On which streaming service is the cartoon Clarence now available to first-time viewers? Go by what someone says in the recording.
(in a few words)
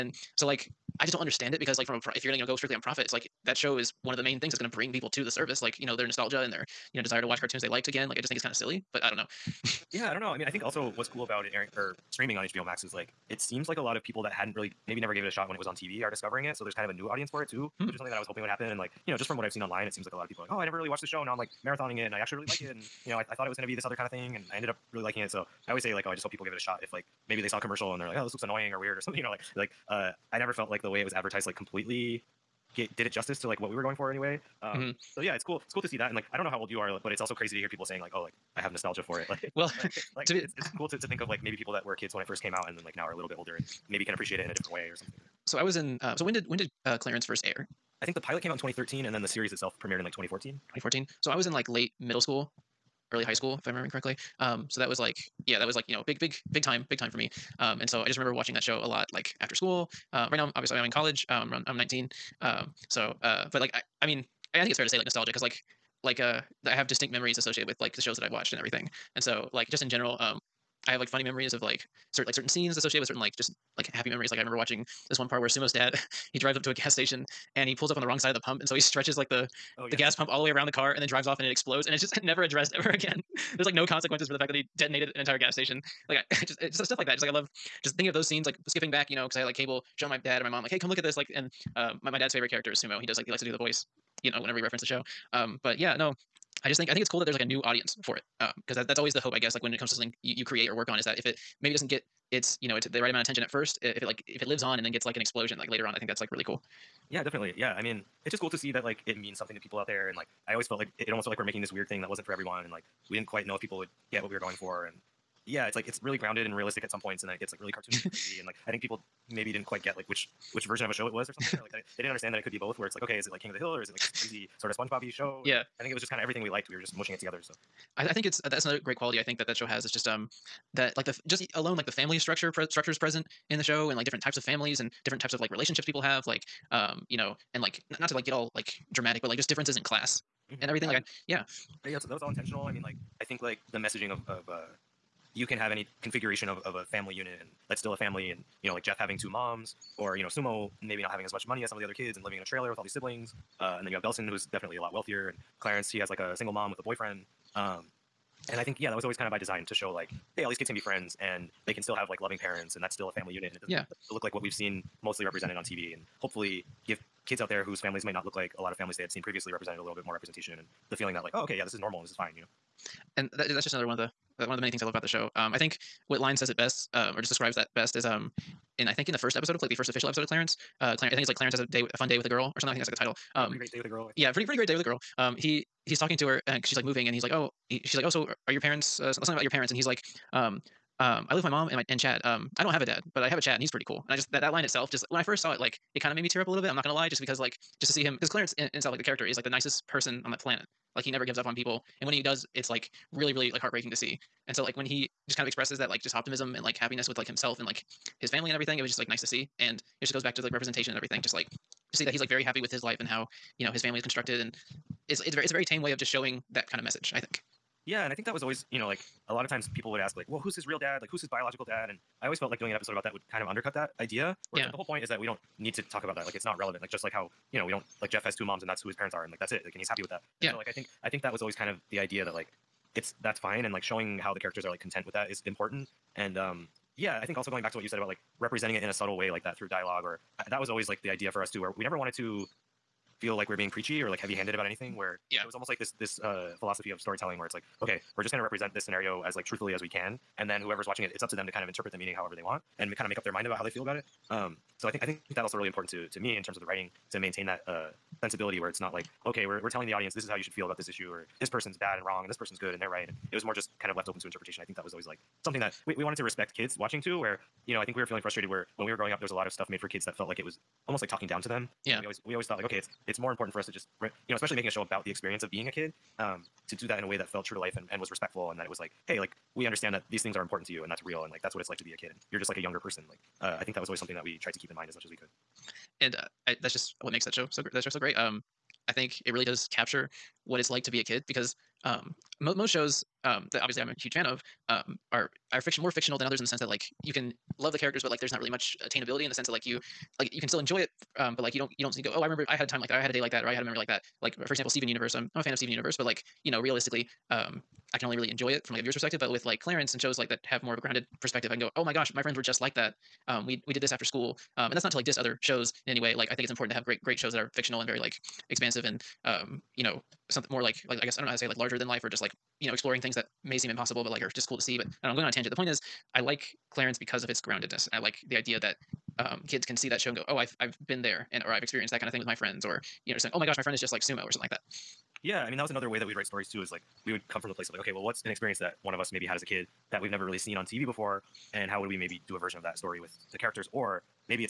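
HBO Max.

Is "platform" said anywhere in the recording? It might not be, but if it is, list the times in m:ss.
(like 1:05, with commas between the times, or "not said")
not said.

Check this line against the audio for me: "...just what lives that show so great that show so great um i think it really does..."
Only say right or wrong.
wrong.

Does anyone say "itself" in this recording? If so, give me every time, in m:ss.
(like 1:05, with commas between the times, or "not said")
0:49, 3:14, 3:18.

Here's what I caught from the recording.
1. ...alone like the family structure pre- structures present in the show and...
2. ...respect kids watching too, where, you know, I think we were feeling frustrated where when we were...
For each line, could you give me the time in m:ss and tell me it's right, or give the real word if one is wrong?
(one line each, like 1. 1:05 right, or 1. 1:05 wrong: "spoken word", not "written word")
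1. 2:11 right
2. 4:26 right.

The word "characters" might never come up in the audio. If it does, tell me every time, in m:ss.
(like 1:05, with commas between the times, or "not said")
1:32, 3:19, 3:54, 4:57, 5:43.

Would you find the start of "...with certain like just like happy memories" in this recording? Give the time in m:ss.
1:13.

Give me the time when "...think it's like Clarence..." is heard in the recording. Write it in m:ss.
3:01.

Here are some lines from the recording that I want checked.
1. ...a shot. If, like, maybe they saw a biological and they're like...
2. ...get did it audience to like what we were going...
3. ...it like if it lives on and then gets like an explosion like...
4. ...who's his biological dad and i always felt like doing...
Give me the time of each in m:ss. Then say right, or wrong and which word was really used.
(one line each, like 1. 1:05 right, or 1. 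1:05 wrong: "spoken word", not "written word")
1. 0:26 wrong: "commercial", not "biological"
2. 0:32 wrong: "justice", not "audience"
3. 1:44 right
4. 3:41 right.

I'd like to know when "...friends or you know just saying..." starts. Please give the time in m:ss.
5:32.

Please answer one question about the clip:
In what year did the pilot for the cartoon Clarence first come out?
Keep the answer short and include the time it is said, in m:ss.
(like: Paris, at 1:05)
2013, at 0:48.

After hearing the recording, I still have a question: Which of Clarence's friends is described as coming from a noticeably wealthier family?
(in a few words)
Belson.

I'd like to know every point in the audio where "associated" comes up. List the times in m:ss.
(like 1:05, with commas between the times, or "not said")
1:07, 1:12.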